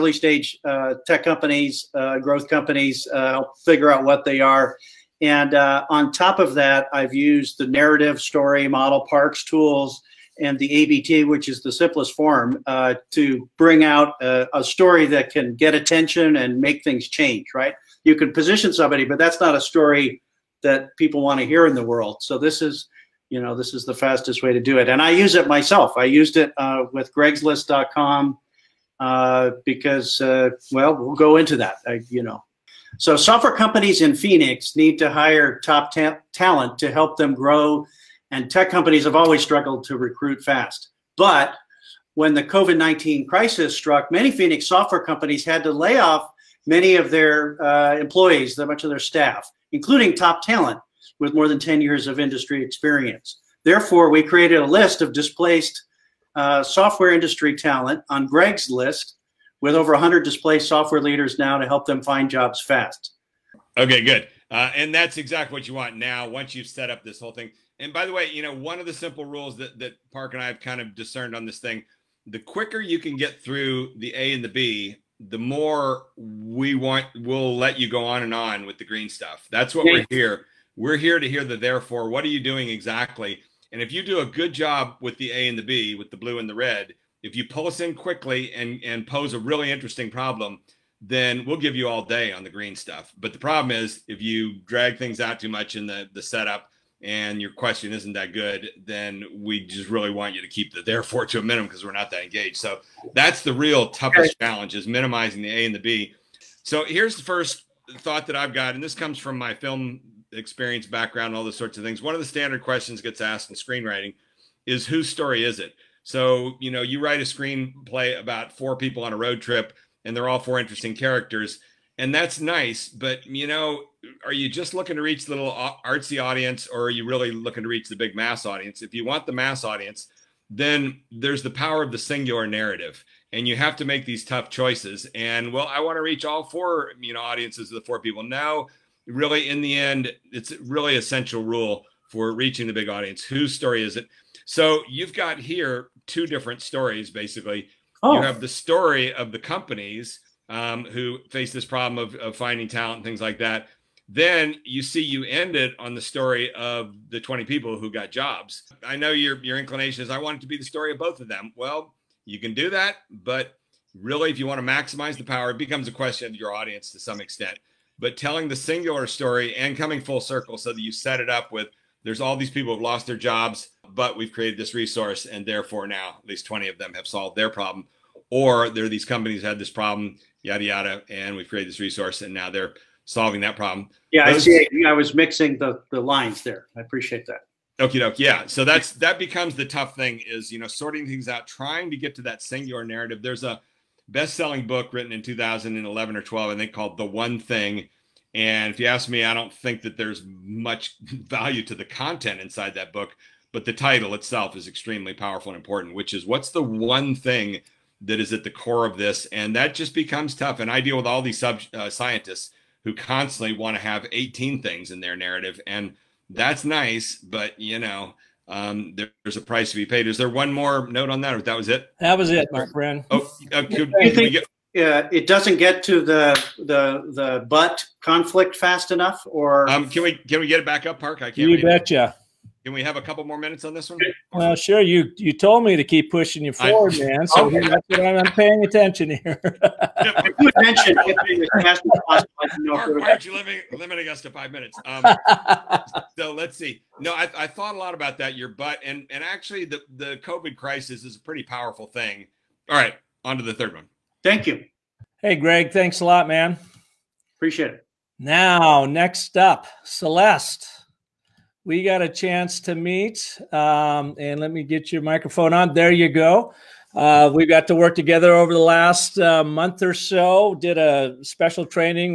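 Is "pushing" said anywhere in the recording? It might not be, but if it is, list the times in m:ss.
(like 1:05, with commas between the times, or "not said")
3:56.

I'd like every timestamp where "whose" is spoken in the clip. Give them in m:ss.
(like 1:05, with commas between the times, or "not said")
1:54, 2:23.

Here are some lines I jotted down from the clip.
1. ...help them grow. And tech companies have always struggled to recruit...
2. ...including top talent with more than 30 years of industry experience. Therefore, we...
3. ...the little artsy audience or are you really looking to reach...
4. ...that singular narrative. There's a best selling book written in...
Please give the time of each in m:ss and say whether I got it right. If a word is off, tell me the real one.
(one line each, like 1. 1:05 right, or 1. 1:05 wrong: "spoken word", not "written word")
1. 0:36 right
2. 0:49 wrong: "10", not "30"
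3. 2:05 right
4. 3:12 right.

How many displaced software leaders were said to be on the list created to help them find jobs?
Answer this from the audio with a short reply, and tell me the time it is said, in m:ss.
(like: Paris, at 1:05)
over 100, at 0:59.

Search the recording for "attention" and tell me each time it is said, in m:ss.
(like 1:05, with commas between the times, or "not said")
0:15, 3:58.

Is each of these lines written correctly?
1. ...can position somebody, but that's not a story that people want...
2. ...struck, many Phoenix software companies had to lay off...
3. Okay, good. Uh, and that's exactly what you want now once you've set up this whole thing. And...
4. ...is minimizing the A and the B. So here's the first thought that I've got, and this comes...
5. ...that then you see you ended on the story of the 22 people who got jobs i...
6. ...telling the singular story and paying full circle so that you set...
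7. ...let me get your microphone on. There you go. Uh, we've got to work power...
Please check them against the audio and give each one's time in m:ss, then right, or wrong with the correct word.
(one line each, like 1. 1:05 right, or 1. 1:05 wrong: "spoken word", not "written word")
1. 0:18 right
2. 0:43 right
3. 1:03 right
4. 1:44 right
5. 2:33 wrong: "20", not "22"
6. 2:48 wrong: "coming", not "paying"
7. 4:24 wrong: "together", not "power".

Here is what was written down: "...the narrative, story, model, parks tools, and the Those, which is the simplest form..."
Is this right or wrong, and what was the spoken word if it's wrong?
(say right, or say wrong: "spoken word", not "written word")
wrong: "ABT", not "Those".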